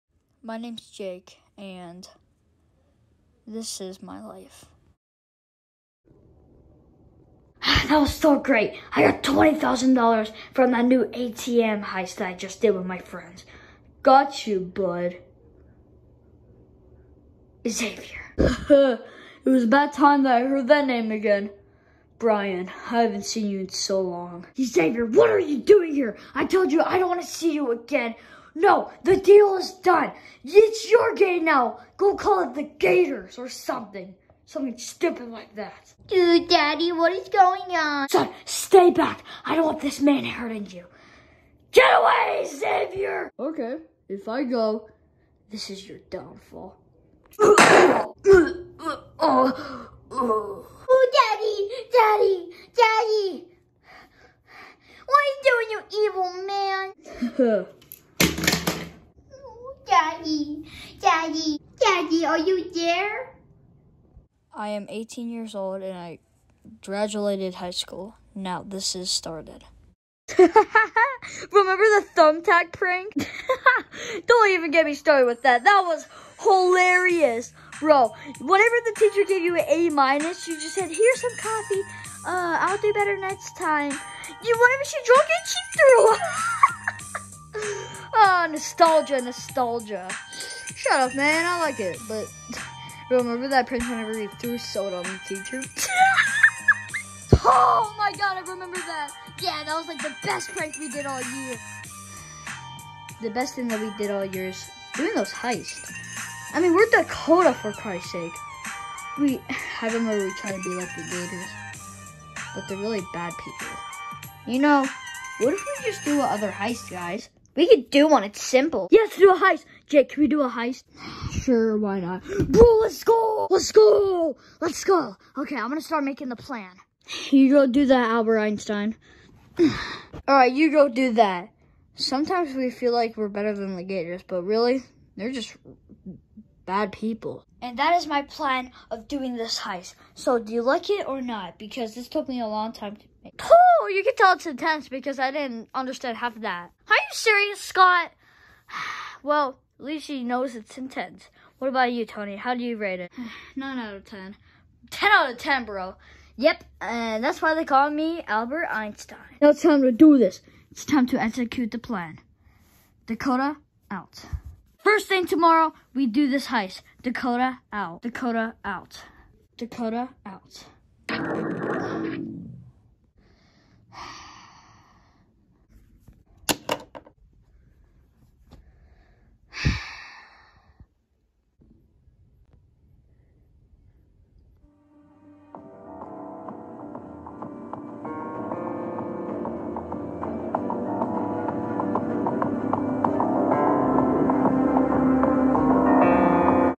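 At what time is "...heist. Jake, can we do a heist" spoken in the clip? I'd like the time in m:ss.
1:59.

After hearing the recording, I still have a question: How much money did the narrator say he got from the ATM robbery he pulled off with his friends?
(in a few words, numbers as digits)
$20,000.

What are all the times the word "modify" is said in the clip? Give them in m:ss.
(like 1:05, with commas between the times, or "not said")
not said.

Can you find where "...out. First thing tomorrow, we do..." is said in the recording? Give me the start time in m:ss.
2:43.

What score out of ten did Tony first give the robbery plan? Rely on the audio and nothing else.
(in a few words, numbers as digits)
9.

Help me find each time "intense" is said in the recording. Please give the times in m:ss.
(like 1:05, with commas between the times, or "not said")
2:24, 2:30.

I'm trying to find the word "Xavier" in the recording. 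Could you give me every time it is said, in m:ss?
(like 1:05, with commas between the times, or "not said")
0:17, 0:24, 0:42.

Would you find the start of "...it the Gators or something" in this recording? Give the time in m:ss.
0:32.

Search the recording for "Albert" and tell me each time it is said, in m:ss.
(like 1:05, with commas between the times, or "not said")
2:08, 2:38.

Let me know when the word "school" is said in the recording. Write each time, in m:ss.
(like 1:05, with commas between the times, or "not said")
1:07.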